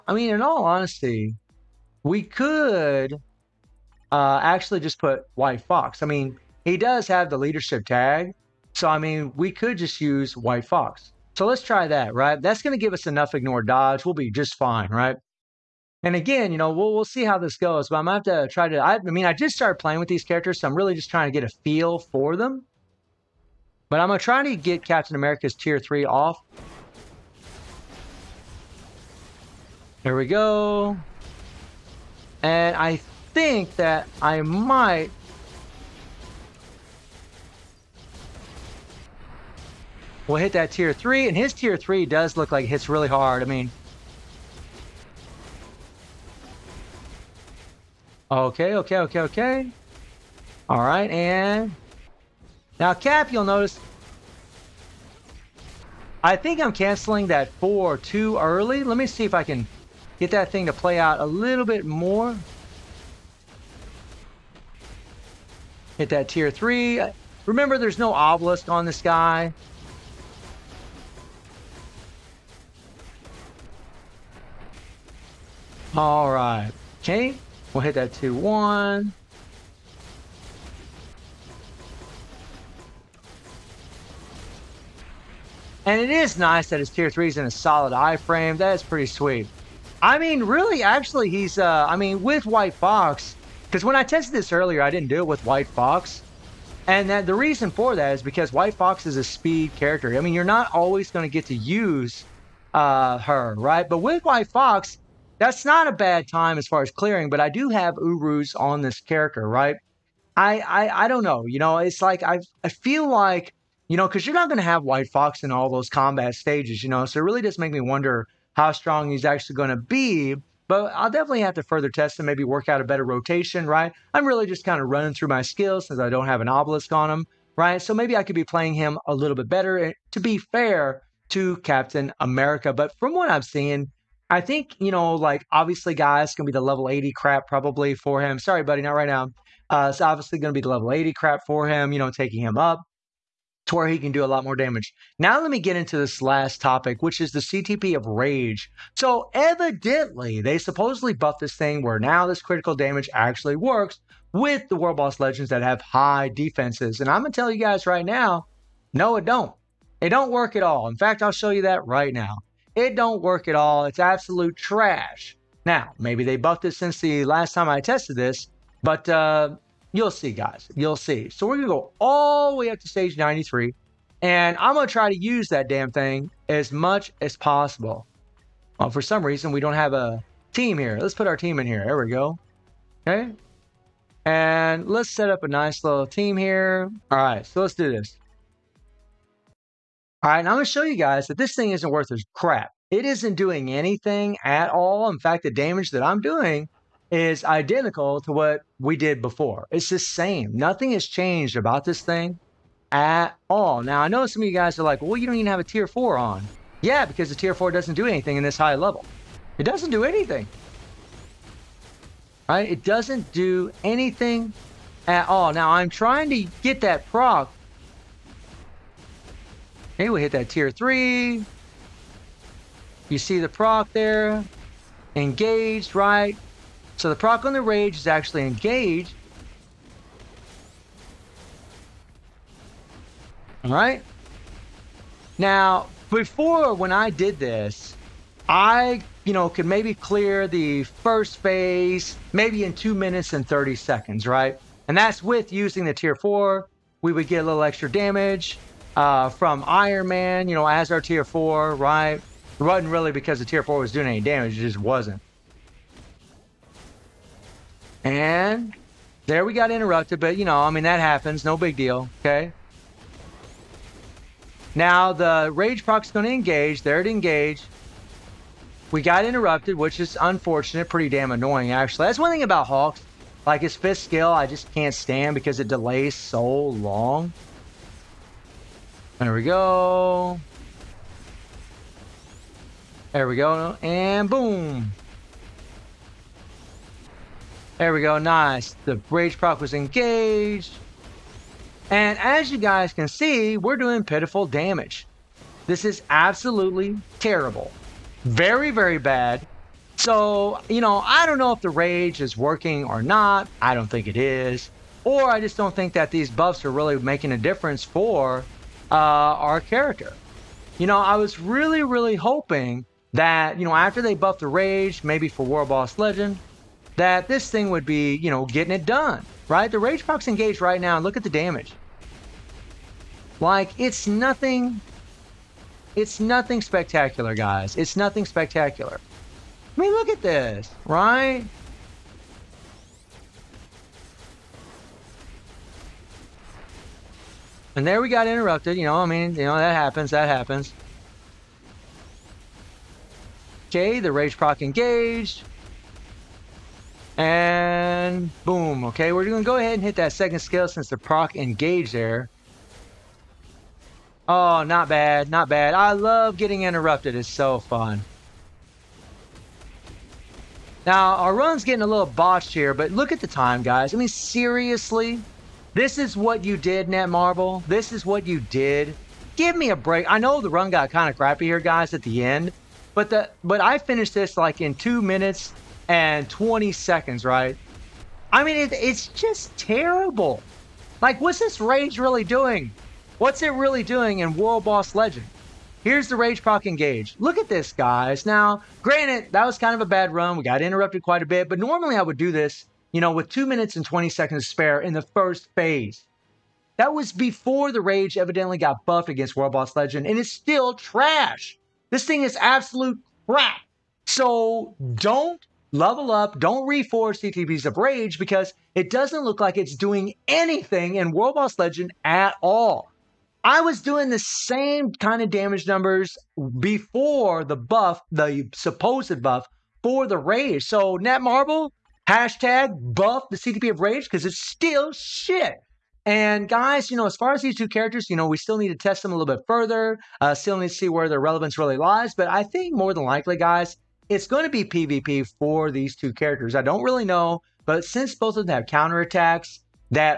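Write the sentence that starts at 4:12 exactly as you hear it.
It wasn't really because the tier four was doing any damage, it just wasn't.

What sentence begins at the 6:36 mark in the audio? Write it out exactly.
That was before the Rage evidently got buffed against World Boss Legend, and it's still trash.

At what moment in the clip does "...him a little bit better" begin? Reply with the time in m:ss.
2:08.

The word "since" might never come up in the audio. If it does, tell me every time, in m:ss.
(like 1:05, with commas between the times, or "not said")
2:05, 2:46, 5:50, 7:17.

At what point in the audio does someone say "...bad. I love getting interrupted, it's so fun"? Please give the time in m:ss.
5:55.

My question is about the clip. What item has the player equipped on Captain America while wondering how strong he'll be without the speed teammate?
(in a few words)
Urus.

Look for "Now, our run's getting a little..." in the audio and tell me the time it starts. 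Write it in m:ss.
6:00.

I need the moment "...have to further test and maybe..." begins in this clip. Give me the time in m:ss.
2:01.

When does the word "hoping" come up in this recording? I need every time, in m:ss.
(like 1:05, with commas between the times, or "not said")
5:12.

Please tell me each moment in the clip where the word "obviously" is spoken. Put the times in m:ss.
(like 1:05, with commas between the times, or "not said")
2:15, 2:20.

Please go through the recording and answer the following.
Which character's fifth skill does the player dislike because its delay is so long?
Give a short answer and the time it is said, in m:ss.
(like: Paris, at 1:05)
Hawks, at 4:32.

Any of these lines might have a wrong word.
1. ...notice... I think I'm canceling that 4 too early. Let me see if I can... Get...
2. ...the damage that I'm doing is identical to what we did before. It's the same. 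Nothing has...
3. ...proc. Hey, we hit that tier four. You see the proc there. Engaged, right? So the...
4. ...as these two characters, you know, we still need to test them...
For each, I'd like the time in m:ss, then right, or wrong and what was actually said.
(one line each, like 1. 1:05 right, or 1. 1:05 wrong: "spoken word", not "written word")
1. 0:53 right
2. 3:15 right
3. 3:37 wrong: "three", not "four"
4. 7:07 right.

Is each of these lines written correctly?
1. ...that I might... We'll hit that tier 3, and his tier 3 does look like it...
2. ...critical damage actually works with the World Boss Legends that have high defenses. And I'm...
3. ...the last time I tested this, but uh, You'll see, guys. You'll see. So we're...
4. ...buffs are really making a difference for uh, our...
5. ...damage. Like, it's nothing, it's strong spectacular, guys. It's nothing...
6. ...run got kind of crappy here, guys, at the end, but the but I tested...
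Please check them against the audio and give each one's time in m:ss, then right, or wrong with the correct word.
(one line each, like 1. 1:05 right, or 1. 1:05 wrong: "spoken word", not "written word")
1. 0:33 right
2. 2:32 right
3. 2:46 right
4. 5:06 right
5. 5:21 wrong: "nothing", not "strong"
6. 6:10 wrong: "finished", not "tested".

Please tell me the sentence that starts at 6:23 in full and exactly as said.
What's it really doing in World Boss Legend?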